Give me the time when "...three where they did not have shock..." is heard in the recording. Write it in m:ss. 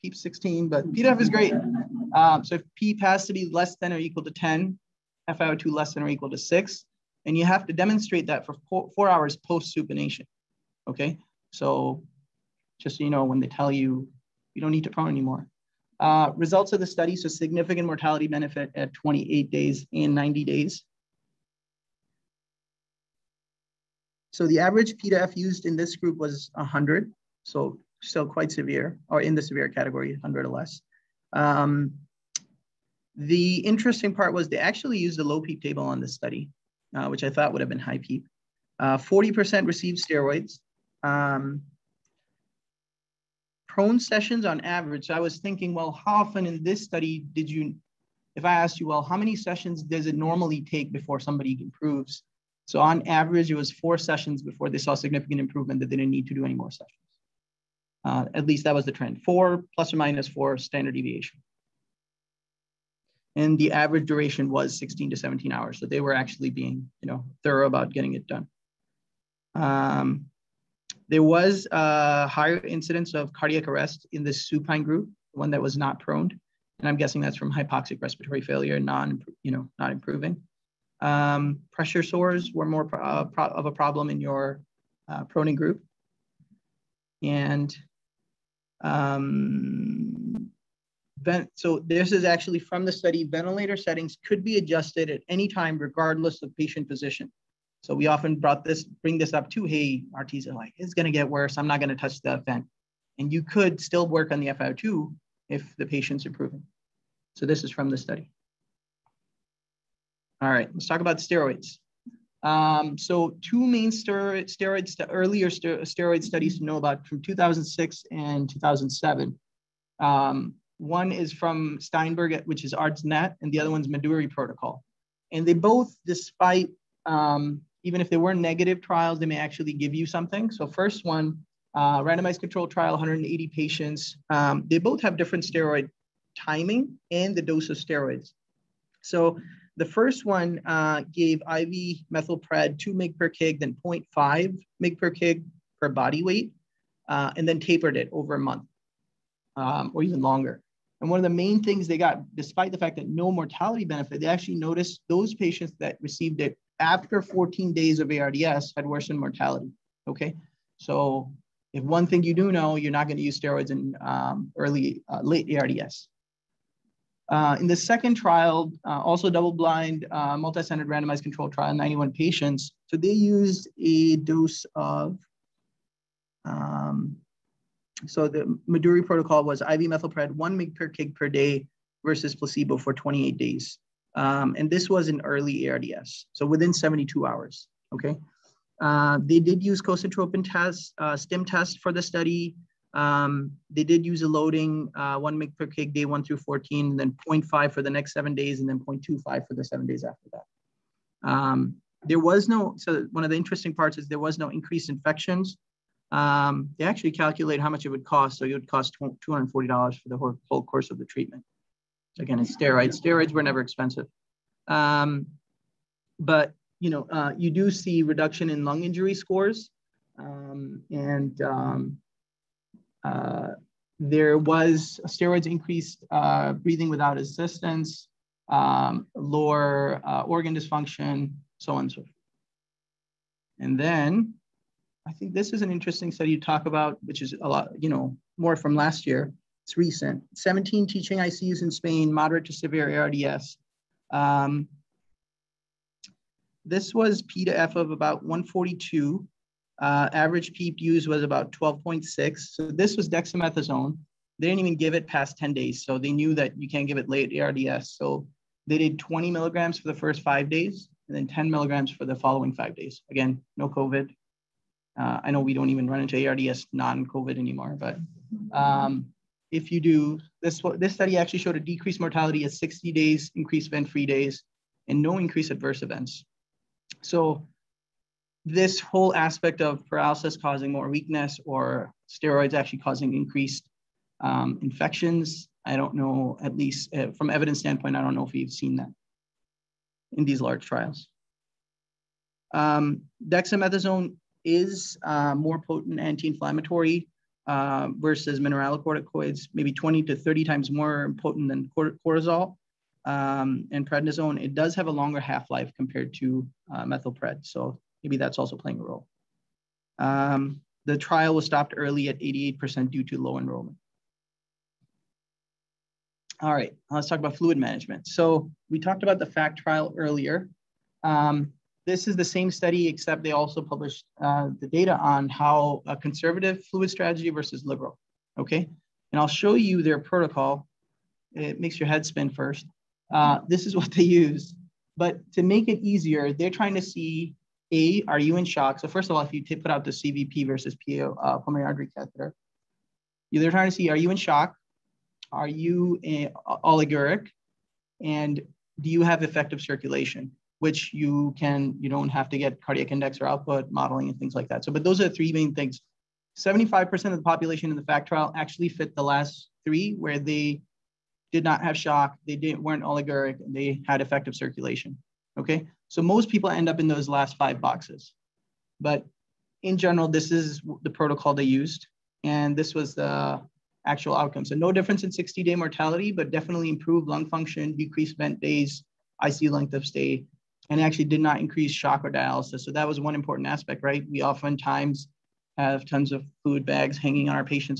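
5:59.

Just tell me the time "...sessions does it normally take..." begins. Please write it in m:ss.
0:49.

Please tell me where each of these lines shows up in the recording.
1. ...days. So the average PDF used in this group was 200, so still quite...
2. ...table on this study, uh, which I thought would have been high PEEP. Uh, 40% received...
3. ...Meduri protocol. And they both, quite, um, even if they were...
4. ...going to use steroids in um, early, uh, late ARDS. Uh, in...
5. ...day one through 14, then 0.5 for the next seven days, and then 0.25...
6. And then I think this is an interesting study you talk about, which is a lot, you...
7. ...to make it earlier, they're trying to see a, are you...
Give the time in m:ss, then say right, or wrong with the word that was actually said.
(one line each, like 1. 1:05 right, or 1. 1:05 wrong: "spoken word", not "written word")
1. 0:20 wrong: "100", not "200"
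2. 0:35 right
3. 2:03 wrong: "despite", not "quite"
4. 2:43 right
5. 3:15 right
6. 3:53 right
7. 5:35 wrong: "easier", not "earlier".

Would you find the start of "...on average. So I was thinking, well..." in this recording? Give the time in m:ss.
0:44.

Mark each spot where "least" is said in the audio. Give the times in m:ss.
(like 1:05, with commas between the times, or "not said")
0:58, 4:46.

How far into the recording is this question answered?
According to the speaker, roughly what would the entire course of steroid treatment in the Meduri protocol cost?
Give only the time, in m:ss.
3:29.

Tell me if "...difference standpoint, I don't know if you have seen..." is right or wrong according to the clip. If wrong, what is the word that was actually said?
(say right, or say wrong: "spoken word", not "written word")
wrong: "evidence", not "difference".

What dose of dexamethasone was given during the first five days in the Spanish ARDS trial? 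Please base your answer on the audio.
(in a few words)
20 milligrams.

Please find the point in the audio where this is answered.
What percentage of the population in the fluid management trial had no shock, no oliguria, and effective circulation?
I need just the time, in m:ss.
5:56.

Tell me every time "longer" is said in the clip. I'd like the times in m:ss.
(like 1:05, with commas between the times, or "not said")
2:30, 5:04.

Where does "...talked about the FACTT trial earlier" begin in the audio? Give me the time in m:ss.
5:18.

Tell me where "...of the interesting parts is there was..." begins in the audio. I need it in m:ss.
3:23.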